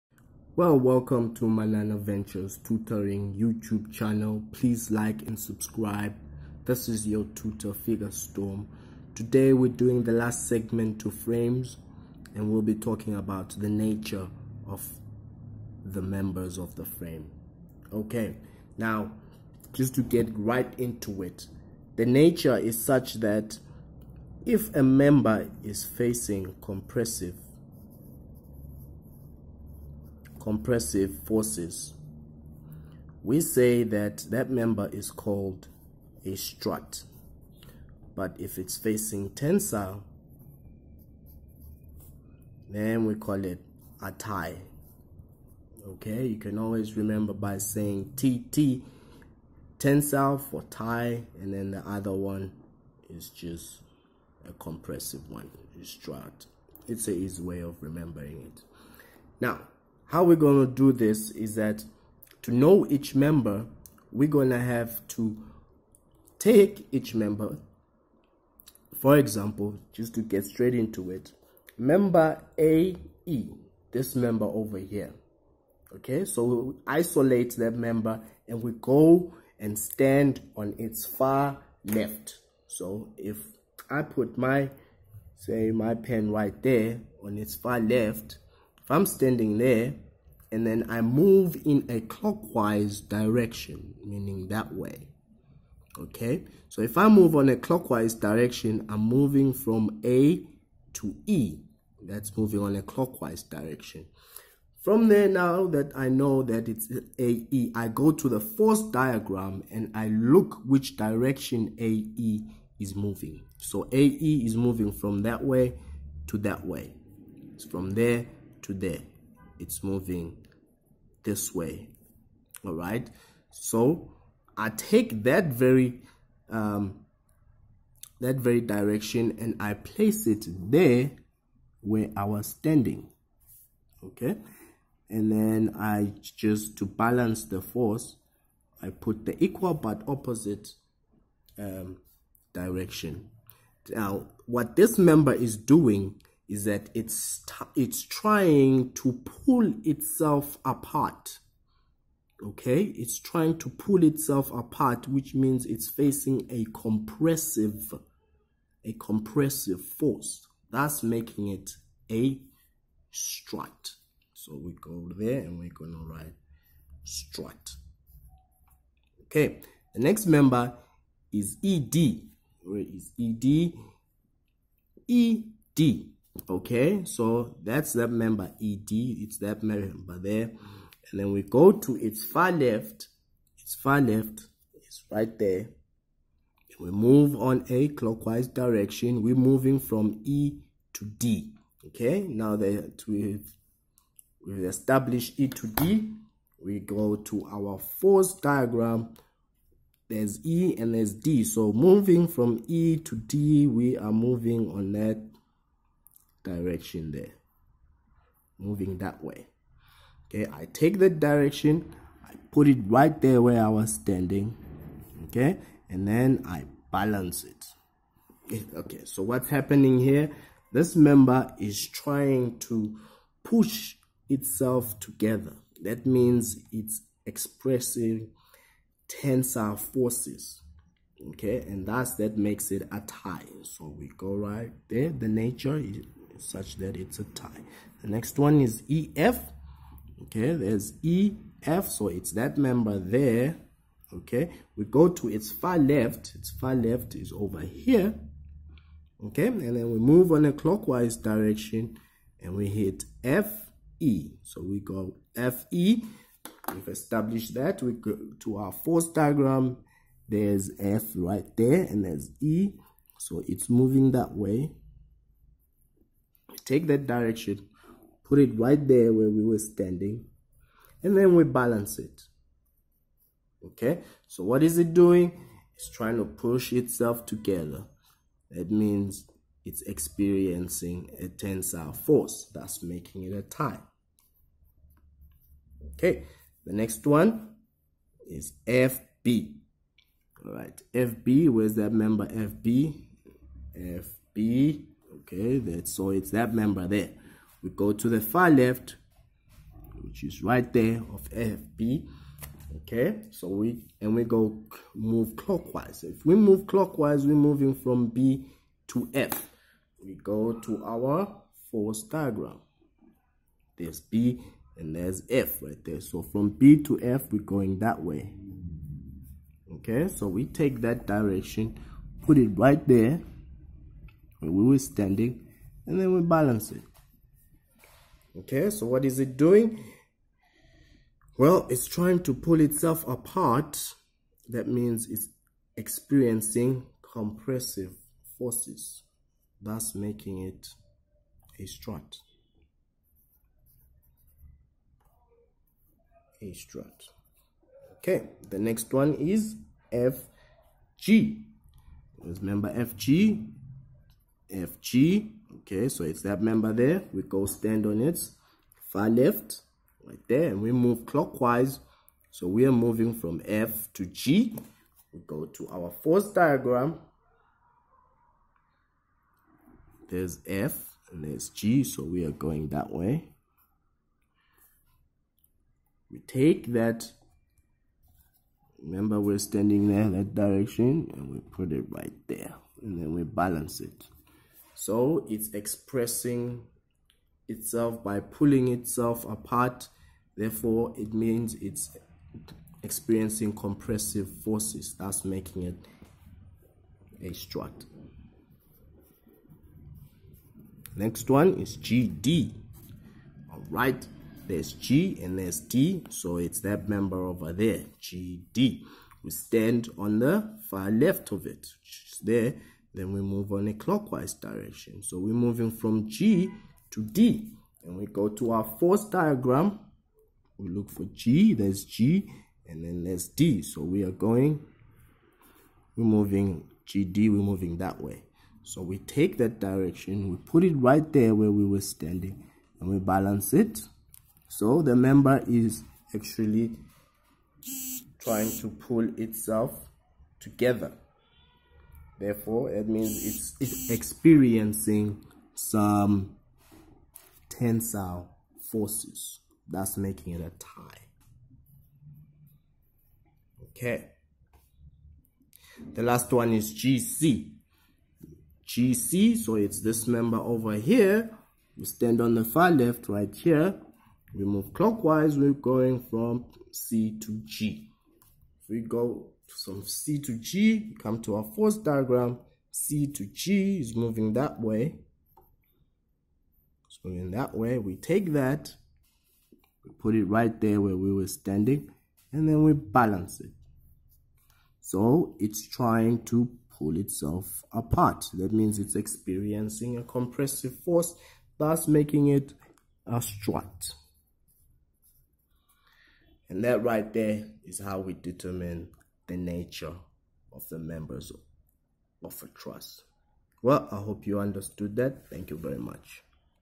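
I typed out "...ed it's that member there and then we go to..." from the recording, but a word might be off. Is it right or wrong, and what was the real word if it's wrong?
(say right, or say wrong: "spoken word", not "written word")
right.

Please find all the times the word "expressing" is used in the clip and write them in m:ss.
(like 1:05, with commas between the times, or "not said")
3:47, 6:25.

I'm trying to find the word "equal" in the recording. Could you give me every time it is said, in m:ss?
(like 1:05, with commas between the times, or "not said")
2:19.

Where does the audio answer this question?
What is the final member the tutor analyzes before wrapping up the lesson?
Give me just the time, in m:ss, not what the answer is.
7:36.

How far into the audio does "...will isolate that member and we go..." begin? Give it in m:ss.
1:16.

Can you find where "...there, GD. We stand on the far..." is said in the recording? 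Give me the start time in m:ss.
6:47.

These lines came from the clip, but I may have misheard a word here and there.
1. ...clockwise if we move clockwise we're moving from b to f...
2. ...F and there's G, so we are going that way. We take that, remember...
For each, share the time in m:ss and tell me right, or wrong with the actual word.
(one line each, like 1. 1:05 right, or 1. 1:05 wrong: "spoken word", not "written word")
1. 5:05 right
2. 6:10 right.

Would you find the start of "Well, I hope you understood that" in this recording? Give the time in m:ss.
8:23.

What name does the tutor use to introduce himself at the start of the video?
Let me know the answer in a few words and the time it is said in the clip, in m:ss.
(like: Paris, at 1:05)
Figure Storm, at 0:07.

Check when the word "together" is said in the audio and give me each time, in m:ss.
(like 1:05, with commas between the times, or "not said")
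3:44, 4:37, 7:20.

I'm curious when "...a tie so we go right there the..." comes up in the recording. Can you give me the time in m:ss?
3:52.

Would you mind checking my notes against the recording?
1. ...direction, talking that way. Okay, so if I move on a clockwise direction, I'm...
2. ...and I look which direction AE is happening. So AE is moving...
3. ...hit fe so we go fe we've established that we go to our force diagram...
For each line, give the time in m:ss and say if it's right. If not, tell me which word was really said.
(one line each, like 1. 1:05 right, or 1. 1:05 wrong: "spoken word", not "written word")
1. 1:32 wrong: "meaning", not "talking"
2. 1:49 wrong: "moving", not "happening"
3. 4:12 right.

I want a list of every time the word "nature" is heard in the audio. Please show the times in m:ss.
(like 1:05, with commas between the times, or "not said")
0:13, 0:22, 3:55, 8:19.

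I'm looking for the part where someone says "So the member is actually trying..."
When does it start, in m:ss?
7:14.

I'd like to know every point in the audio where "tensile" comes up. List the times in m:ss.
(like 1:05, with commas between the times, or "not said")
0:39, 0:49, 3:49, 4:41, 7:27.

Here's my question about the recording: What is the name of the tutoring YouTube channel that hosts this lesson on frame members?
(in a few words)
Manana Ventures Tutoring.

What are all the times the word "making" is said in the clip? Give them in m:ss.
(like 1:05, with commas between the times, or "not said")
2:41, 4:42, 5:39, 6:35, 7:29, 8:11.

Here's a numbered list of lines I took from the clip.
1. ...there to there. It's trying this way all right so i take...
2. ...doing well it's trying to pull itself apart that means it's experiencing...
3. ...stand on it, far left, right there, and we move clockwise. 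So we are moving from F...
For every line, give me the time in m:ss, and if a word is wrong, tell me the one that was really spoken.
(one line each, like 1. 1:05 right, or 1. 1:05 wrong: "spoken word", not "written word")
1. 1:57 wrong: "moving", not "trying"
2. 5:29 right
3. 5:57 right.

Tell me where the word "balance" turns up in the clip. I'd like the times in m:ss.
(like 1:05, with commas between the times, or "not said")
2:16, 3:36, 4:31, 5:26, 6:23, 7:12, 8:02.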